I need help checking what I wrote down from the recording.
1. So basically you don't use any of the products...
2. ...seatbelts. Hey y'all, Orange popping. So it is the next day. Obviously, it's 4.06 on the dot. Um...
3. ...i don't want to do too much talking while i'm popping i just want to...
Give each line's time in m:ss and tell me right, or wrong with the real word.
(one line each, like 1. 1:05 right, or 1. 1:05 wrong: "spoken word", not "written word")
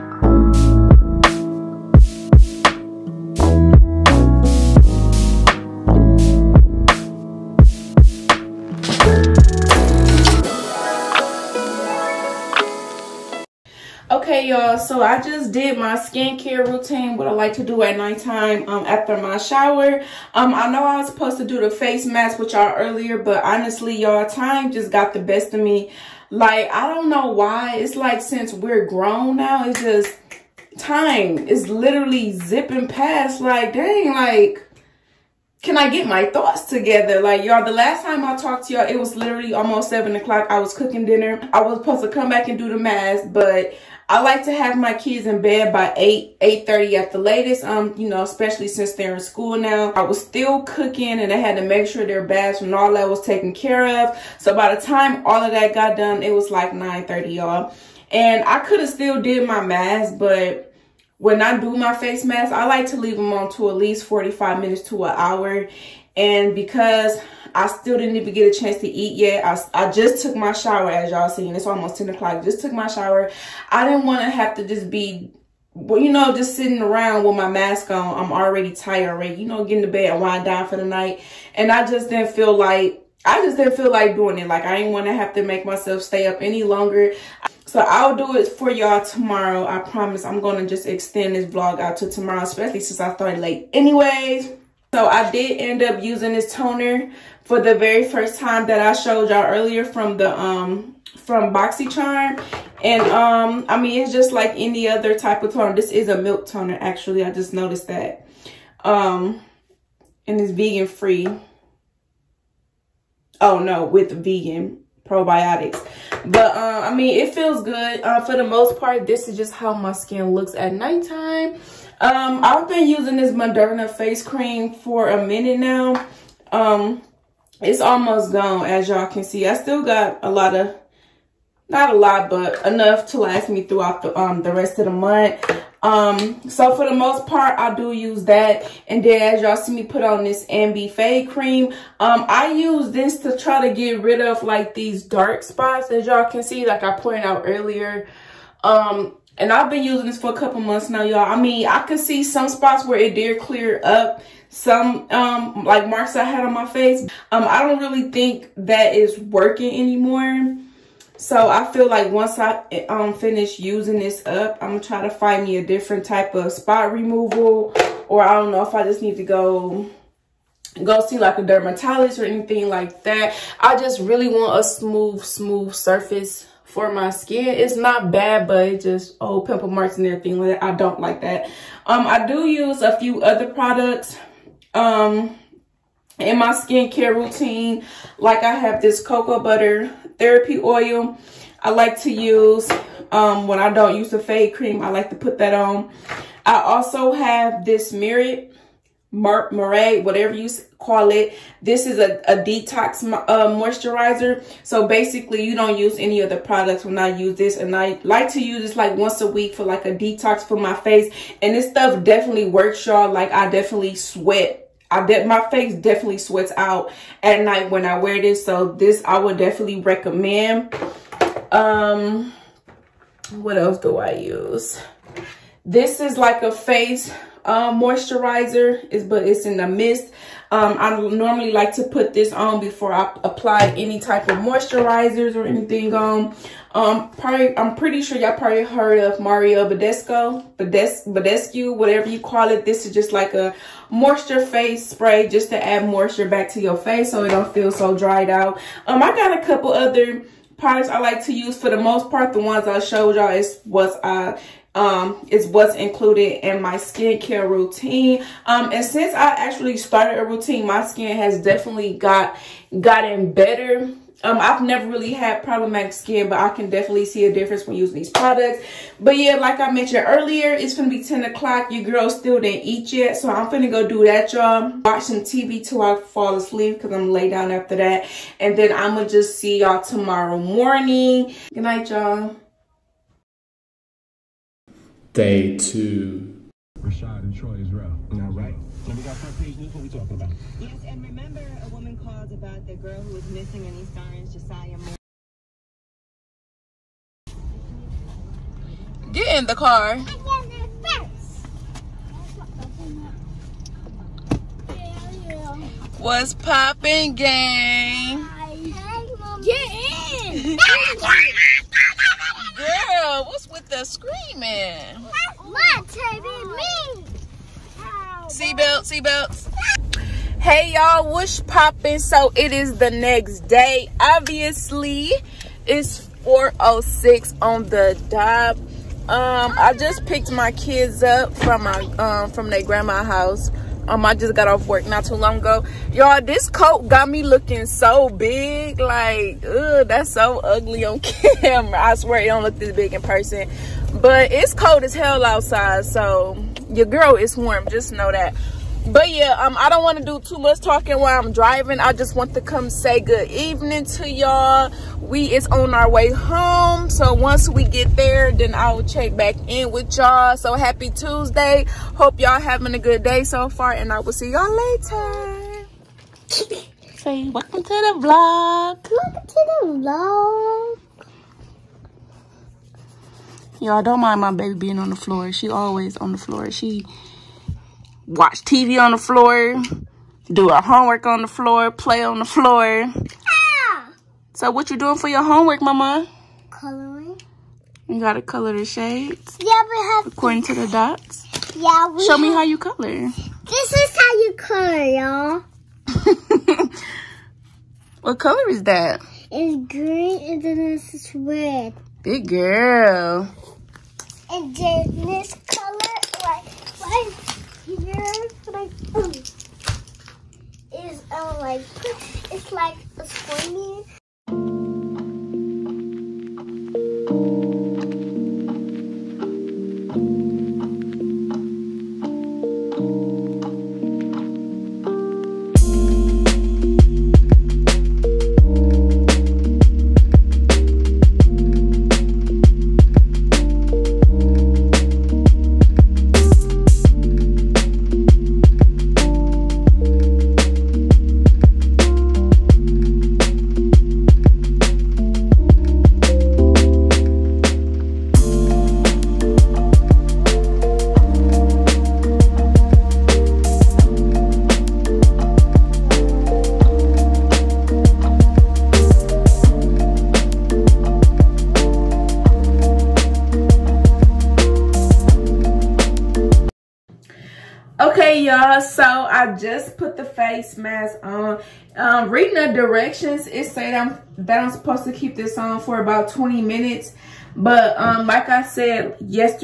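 1. 3:24 right
2. 5:18 wrong: "Wish", not "Orange"
3. 5:49 wrong: "driving", not "popping".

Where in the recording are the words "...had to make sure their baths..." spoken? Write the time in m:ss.
0:51.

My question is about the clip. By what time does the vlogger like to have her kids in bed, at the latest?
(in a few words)
8:30.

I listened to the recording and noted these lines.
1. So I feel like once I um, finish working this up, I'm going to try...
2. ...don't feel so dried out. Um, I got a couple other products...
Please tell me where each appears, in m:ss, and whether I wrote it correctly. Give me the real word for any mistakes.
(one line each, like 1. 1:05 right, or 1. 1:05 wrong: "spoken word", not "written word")
1. 2:41 wrong: "using", not "working"
2. 4:07 right.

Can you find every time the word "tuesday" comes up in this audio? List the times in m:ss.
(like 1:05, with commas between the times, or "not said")
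6:00.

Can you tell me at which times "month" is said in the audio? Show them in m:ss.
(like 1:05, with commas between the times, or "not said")
2:14, 2:30.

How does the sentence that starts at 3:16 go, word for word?
I also have this Merit Mar whatever you call it.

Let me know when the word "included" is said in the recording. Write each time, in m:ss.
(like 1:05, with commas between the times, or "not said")
4:15.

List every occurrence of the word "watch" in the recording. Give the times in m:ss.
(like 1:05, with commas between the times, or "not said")
4:34, 6:18.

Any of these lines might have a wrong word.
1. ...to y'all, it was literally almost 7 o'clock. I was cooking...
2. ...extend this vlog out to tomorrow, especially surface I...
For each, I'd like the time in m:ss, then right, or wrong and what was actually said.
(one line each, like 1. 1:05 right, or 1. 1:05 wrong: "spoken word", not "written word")
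1. 0:38 right
2. 1:30 wrong: "since", not "surface".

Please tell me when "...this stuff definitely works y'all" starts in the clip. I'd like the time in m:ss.
3:31.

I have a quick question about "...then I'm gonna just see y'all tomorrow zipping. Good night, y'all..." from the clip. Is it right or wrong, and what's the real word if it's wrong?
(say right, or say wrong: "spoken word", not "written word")
wrong: "morning", not "zipping".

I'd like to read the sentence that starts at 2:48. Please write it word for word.
Or I don't know if I just need to go go see like a dermatologist or anything like that.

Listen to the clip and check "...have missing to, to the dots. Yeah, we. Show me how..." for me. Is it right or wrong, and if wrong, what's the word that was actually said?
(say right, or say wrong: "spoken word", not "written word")
wrong: "according", not "missing".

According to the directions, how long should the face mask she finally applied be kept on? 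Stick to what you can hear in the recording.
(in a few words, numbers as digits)
20 minutes.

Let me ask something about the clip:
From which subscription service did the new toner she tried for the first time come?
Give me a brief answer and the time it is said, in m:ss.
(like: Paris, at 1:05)
BoxyCharm, at 1:41.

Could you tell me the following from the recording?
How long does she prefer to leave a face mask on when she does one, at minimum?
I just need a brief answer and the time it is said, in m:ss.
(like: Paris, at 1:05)
45 minutes, at 1:04.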